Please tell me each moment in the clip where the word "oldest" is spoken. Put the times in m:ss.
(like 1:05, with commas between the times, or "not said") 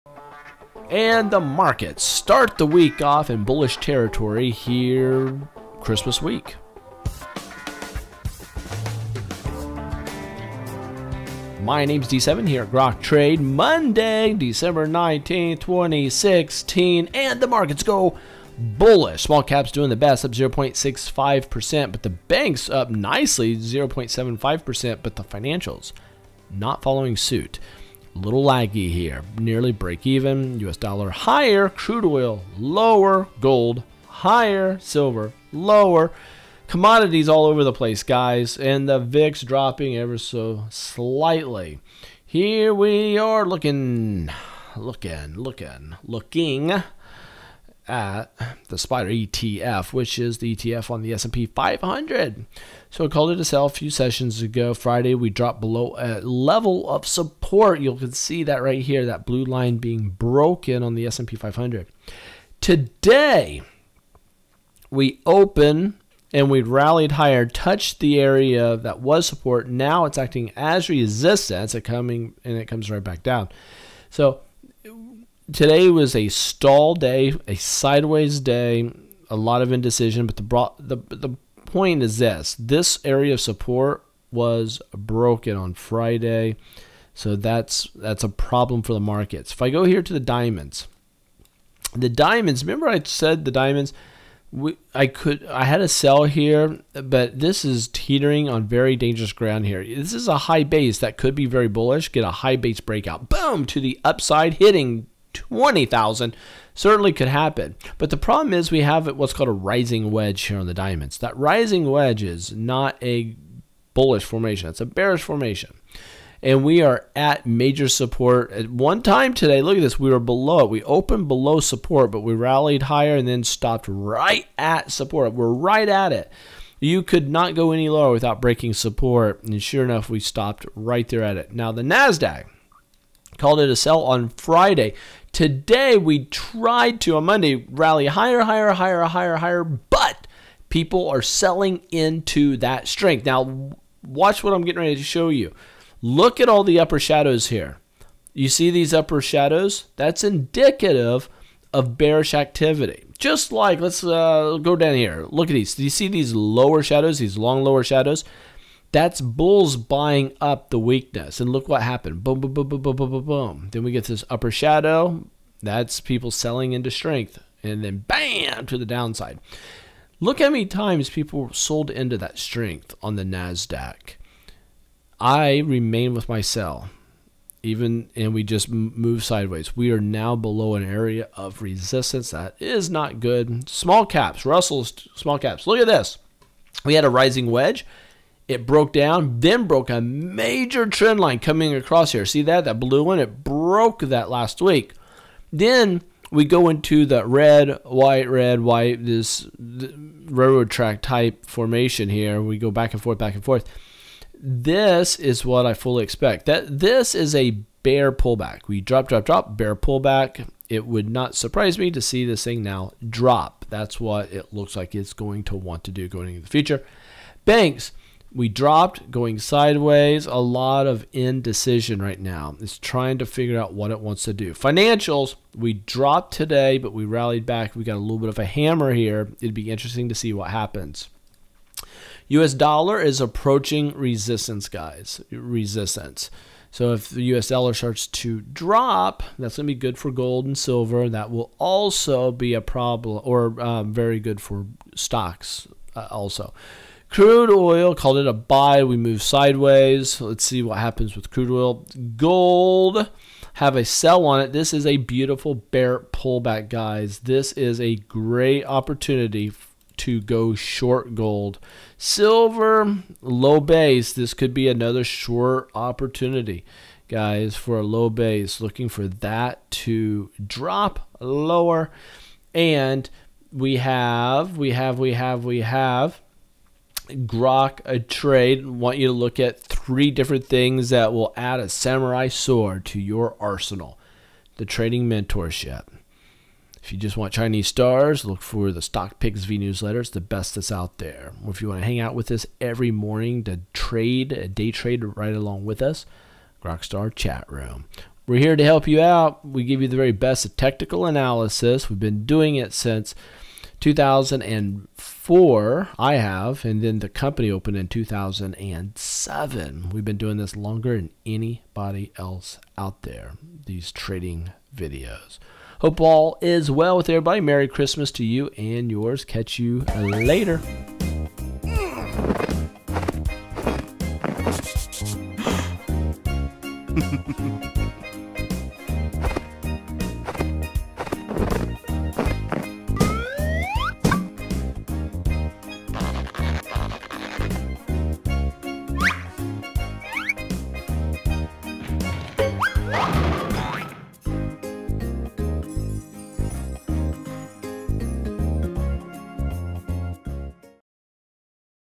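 not said.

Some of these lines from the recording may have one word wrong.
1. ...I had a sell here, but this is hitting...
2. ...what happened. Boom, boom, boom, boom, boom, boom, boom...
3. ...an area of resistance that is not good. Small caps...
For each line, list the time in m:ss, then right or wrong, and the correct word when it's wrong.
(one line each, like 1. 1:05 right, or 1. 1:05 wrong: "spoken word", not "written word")
1. 1:35 wrong: "teetering", not "hitting"
2. 2:41 right
3. 3:00 right.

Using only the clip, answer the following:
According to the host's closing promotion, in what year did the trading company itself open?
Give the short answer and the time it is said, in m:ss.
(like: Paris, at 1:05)
2007, at 5:07.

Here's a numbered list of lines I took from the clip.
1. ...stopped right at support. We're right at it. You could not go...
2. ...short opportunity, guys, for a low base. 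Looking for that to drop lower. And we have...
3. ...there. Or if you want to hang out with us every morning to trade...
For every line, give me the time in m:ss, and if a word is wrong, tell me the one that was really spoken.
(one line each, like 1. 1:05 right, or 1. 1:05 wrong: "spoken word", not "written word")
1. 2:03 right
2. 4:25 right
3. 4:50 right.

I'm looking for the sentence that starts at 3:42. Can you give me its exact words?
It's trying to figure out what it wants to do.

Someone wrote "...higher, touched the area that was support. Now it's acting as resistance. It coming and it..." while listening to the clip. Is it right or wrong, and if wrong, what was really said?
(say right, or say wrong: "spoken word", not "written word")
right.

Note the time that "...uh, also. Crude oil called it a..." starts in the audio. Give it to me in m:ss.
4:05.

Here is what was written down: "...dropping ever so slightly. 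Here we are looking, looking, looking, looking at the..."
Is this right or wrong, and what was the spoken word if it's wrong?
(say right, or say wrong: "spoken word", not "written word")
right.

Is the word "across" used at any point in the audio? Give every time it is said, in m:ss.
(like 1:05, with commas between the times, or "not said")
3:11.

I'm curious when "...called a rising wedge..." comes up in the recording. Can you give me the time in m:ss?
1:49.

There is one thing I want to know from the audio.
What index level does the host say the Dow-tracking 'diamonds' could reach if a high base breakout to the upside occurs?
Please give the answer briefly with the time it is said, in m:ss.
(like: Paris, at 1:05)
20,000, at 1:45.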